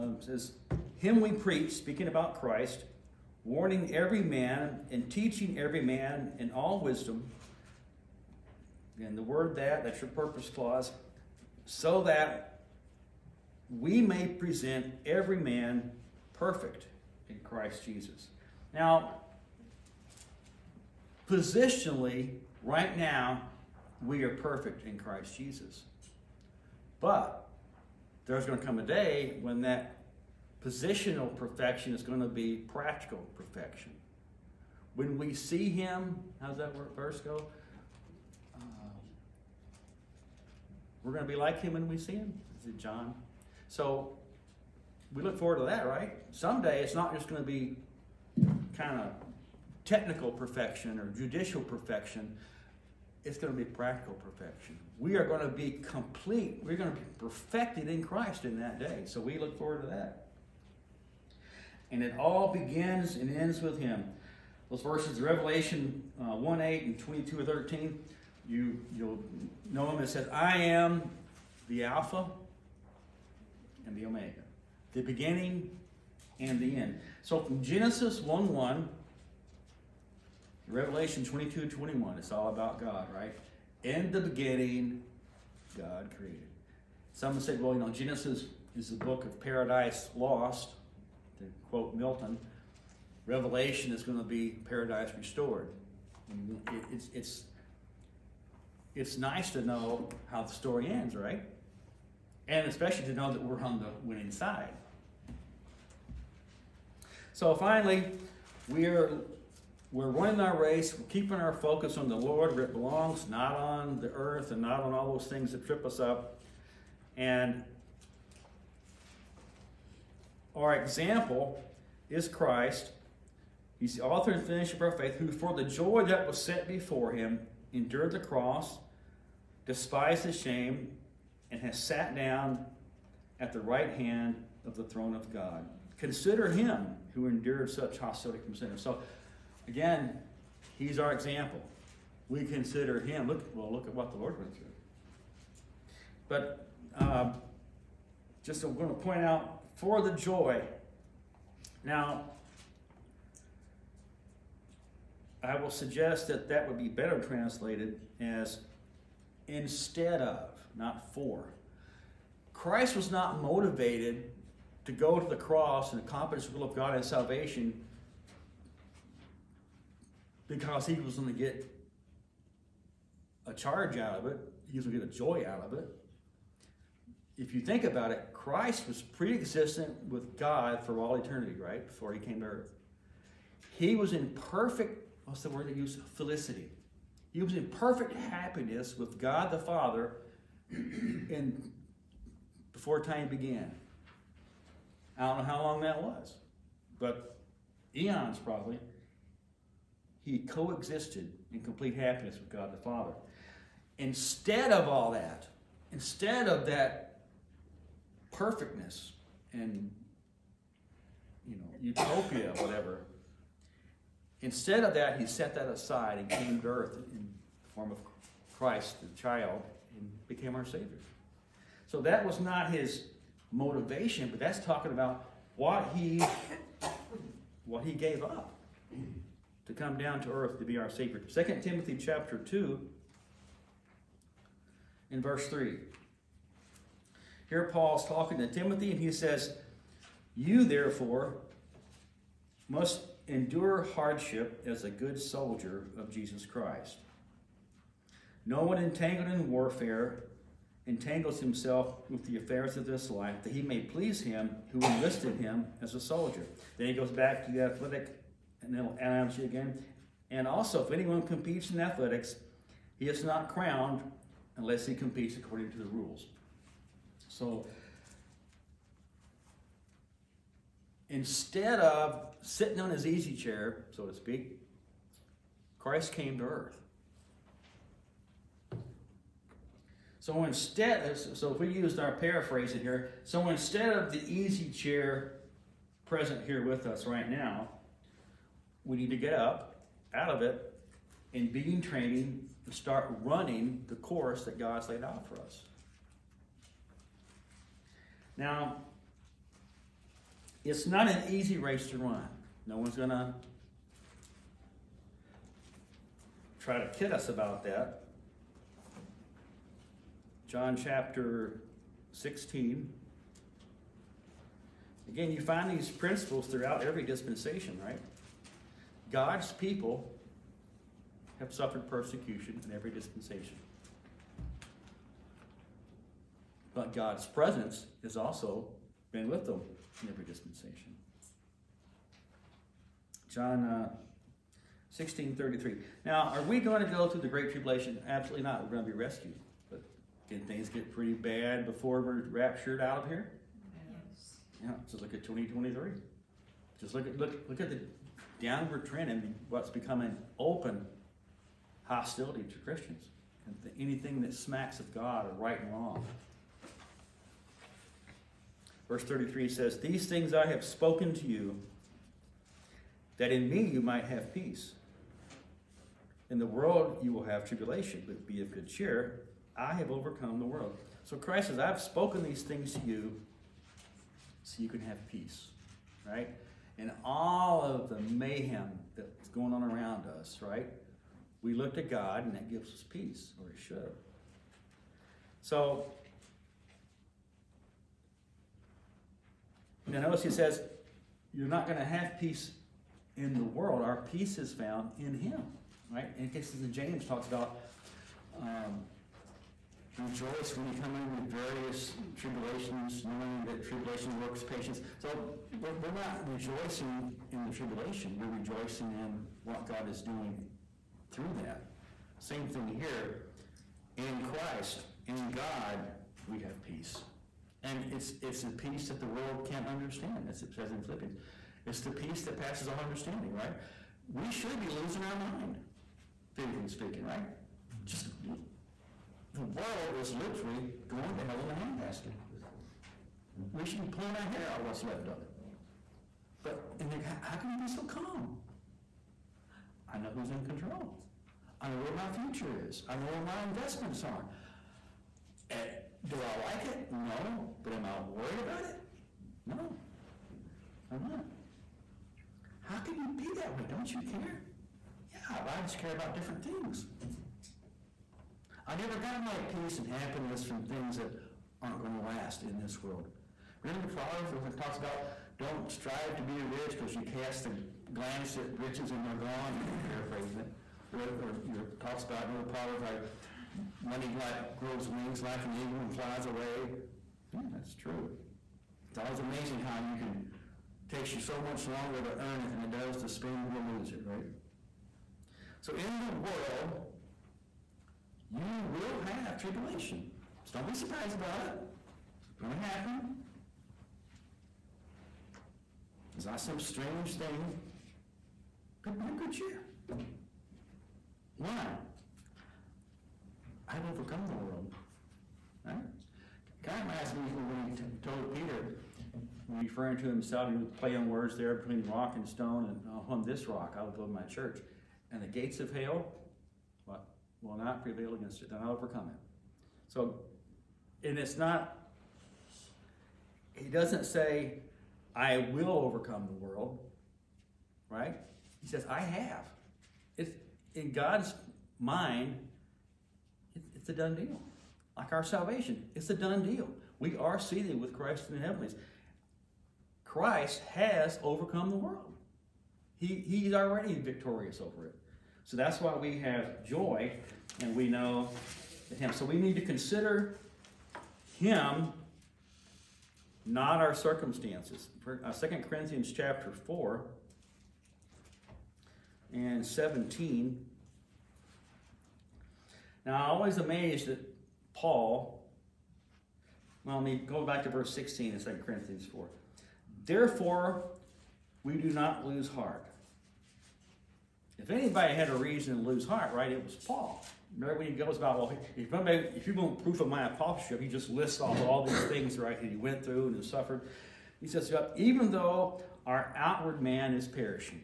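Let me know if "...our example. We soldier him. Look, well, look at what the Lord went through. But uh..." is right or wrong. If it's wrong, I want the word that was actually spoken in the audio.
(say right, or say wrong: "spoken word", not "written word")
wrong: "consider", not "soldier".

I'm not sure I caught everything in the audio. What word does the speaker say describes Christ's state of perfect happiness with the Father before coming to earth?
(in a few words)
Felicity.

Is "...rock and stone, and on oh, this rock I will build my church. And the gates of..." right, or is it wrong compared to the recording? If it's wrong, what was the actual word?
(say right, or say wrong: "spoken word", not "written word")
right.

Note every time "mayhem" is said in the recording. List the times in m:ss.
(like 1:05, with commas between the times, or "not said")
6:18.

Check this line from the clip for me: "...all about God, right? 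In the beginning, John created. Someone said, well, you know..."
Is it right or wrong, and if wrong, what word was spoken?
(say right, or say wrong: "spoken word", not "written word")
wrong: "God", not "John".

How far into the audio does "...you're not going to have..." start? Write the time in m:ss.
6:31.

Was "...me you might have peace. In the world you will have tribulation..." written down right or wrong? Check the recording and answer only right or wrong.
right.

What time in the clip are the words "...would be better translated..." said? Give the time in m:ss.
2:36.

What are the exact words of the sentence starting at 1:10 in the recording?
It says, I am the Alpha and the Omega, the beginning and the end.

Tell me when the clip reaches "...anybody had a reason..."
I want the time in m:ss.
9:34.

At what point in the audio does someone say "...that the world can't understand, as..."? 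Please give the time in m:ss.
6:58.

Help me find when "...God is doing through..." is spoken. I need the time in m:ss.
6:49.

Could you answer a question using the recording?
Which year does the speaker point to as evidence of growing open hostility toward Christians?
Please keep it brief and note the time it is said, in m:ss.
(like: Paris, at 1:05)
2023, at 5:45.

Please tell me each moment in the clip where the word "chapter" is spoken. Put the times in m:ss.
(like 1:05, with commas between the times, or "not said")
3:51, 5:10, 9:16.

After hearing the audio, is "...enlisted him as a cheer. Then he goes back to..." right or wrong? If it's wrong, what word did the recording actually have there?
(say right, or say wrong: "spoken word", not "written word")
wrong: "soldier", not "cheer".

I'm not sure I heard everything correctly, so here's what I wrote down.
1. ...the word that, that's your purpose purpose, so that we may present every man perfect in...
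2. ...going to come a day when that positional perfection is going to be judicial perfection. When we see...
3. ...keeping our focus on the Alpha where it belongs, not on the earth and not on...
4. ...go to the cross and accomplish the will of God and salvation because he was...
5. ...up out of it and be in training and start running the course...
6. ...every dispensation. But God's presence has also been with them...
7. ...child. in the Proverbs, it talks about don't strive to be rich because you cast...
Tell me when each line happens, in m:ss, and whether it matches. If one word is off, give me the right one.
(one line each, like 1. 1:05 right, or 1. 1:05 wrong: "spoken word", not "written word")
1. 0:09 wrong: "clause", not "purpose"
2. 0:28 wrong: "practical", not "judicial"
3. 1:51 wrong: "Lord", not "Alpha"
4. 2:44 right
5. 4:49 right
6. 5:22 right
7. 7:42 wrong: "world", not "child".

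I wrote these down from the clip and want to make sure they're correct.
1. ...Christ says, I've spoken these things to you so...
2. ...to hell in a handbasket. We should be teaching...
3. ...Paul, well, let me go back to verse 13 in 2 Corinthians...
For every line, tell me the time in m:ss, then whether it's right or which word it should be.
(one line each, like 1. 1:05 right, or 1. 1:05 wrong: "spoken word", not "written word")
1. 6:11 right
2. 7:11 wrong: "pulling", not "teaching"
3. 9:24 wrong: "16", not "13".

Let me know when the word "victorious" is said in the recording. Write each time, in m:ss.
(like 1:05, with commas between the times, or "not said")
9:03.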